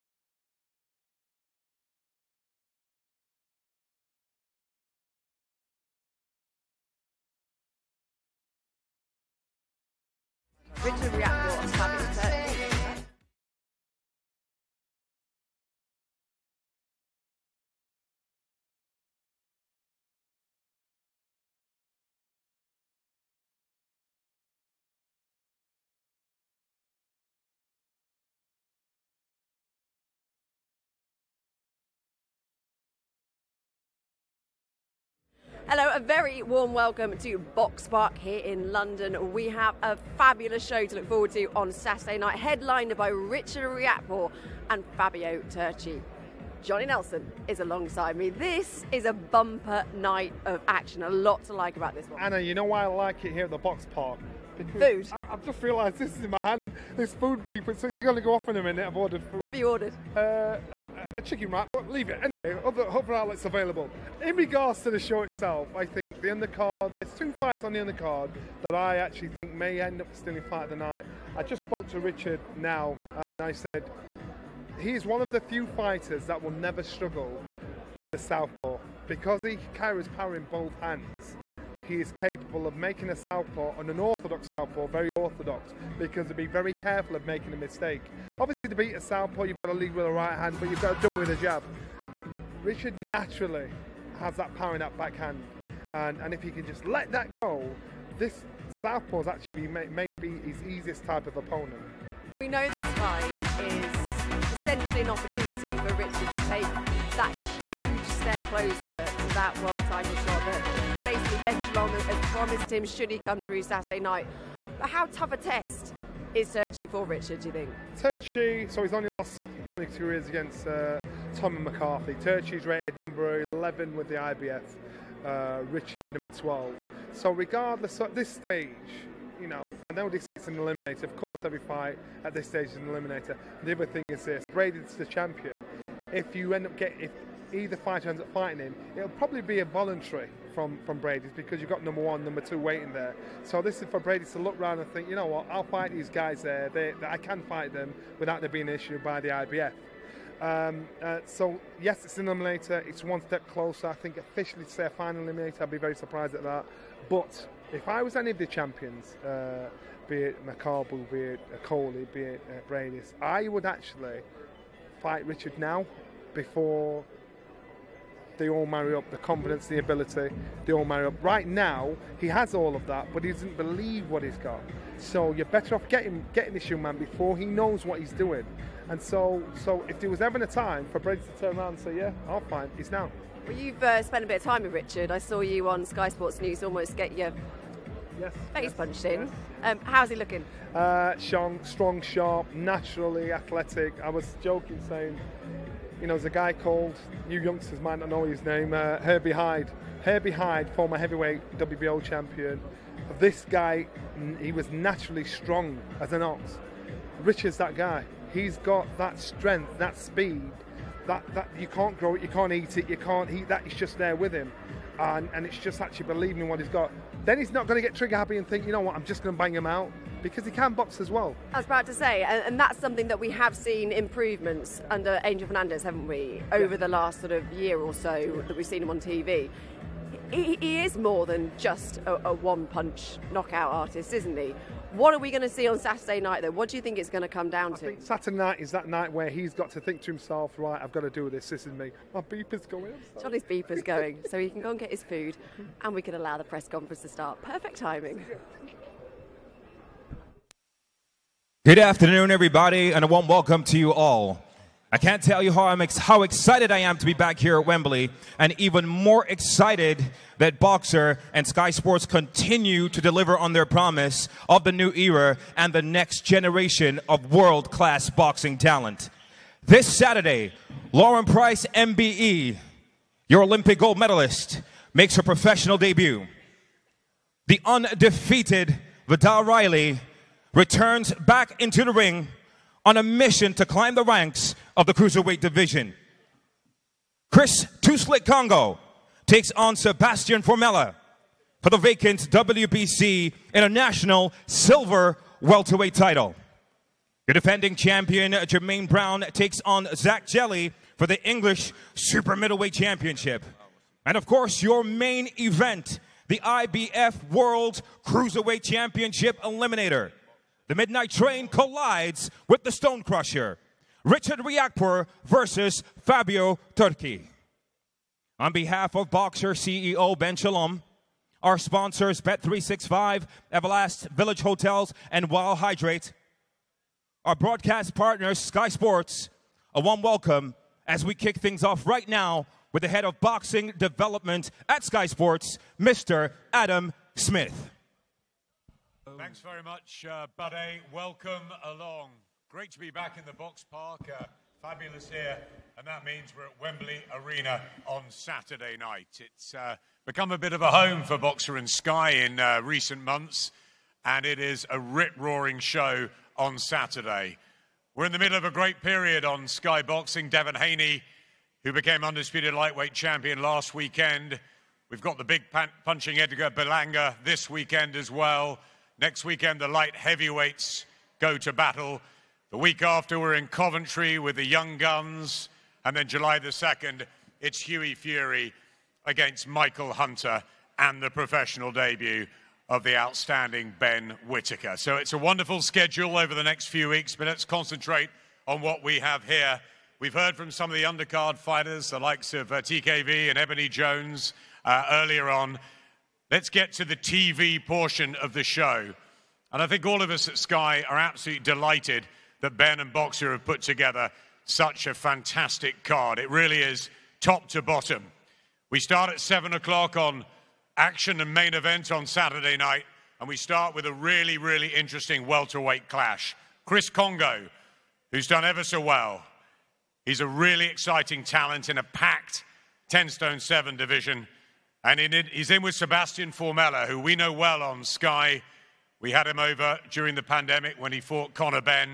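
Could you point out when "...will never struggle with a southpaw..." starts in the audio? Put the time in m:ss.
1:16.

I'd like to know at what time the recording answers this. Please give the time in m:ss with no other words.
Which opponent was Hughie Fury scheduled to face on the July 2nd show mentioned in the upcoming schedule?
6:19.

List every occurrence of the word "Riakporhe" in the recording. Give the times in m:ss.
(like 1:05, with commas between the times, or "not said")
0:43, 5:14.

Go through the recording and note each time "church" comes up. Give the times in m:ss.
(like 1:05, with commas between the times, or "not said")
not said.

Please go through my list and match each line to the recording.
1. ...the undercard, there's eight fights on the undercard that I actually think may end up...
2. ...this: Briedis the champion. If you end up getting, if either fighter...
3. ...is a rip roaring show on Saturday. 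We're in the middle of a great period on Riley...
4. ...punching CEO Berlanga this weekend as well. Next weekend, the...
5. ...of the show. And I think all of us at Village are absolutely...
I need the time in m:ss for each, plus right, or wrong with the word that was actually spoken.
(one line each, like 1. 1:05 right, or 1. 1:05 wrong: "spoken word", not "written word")
1. 1:06 wrong: "two", not "eight"
2. 2:14 right
3. 5:54 wrong: "Sky", not "Riley"
4. 6:05 wrong: "Edgar", not "CEO"
5. 6:38 wrong: "Sky", not "Village".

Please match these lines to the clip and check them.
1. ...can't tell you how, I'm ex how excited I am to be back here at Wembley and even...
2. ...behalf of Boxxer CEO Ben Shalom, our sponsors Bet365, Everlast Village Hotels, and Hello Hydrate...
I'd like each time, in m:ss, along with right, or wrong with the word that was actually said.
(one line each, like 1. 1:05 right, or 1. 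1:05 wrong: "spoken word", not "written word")
1. 4:14 right
2. 5:18 wrong: "Wild", not "Hello".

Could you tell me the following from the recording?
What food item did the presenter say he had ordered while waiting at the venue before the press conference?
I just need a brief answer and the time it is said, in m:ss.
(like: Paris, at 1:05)
Chicken wrap, at 1:01.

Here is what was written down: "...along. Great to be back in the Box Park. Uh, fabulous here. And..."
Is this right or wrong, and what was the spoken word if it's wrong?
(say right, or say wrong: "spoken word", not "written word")
right.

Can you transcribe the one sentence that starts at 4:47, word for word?
Chris Two Slick Kongo takes on Sebastian Formella for the vacant WBC International Silver Welterweight title.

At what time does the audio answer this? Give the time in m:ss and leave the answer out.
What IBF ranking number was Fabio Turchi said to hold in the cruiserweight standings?
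2:02.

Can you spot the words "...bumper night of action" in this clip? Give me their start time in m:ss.
0:49.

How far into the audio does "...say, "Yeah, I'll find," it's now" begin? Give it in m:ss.
3:01.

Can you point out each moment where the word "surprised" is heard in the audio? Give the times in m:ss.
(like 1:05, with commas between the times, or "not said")
2:35.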